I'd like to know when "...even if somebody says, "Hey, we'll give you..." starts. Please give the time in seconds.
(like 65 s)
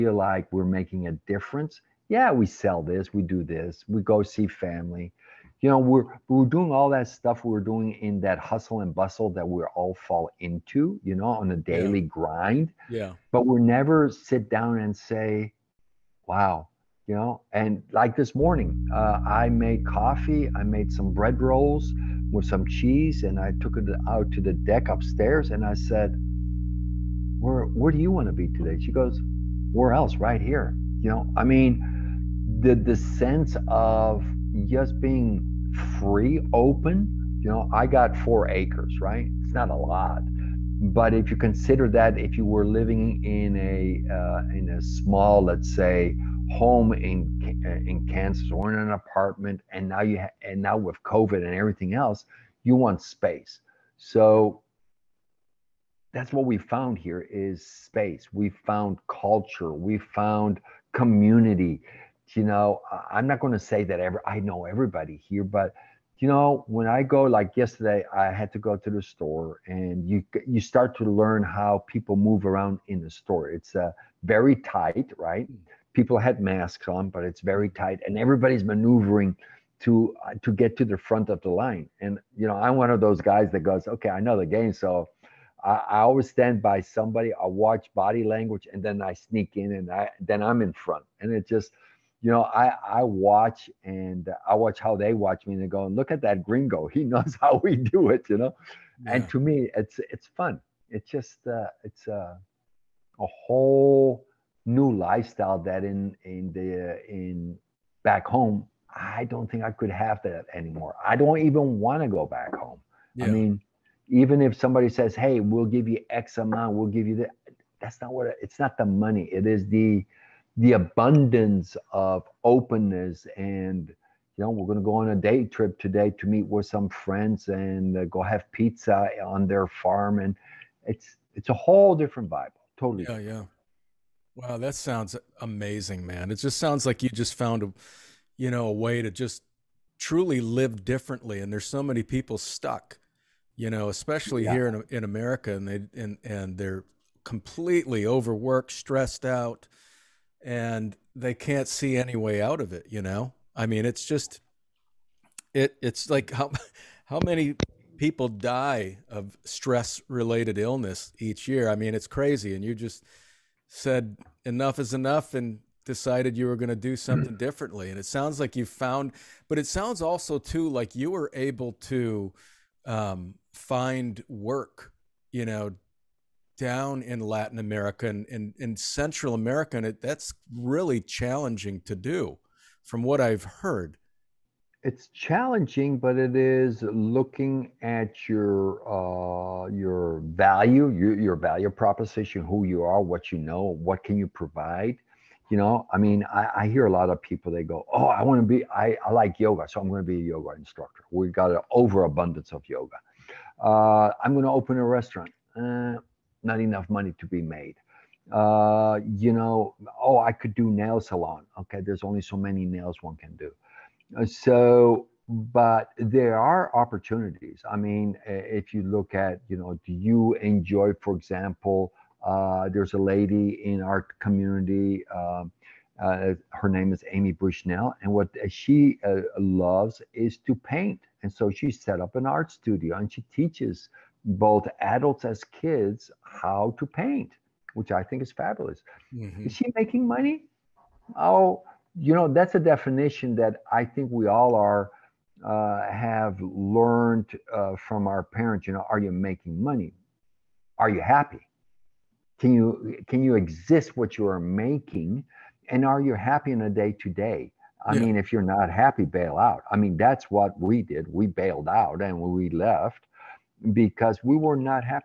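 114 s.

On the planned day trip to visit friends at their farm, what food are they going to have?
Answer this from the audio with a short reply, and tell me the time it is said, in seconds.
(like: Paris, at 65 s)
Pizza, at 128 s.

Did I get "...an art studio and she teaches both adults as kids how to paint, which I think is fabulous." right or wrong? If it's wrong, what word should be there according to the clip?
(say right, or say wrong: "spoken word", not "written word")
right.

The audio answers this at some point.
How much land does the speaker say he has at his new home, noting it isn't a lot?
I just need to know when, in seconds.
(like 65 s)
38 s.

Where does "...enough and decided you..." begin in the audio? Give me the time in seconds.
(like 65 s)
164 s.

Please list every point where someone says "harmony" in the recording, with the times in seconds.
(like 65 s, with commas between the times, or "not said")
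not said.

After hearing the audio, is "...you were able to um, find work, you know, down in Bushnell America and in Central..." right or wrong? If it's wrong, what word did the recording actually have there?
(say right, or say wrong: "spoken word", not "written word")
wrong: "Latin", not "Bushnell".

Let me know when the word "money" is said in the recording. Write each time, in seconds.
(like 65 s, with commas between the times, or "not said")
118 s, 206 s, 240 s, 249 s.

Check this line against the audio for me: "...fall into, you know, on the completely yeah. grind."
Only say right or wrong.
wrong.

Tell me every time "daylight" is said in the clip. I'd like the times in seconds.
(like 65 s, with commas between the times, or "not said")
not said.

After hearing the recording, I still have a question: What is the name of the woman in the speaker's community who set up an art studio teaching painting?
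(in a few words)
Amy Bushnell.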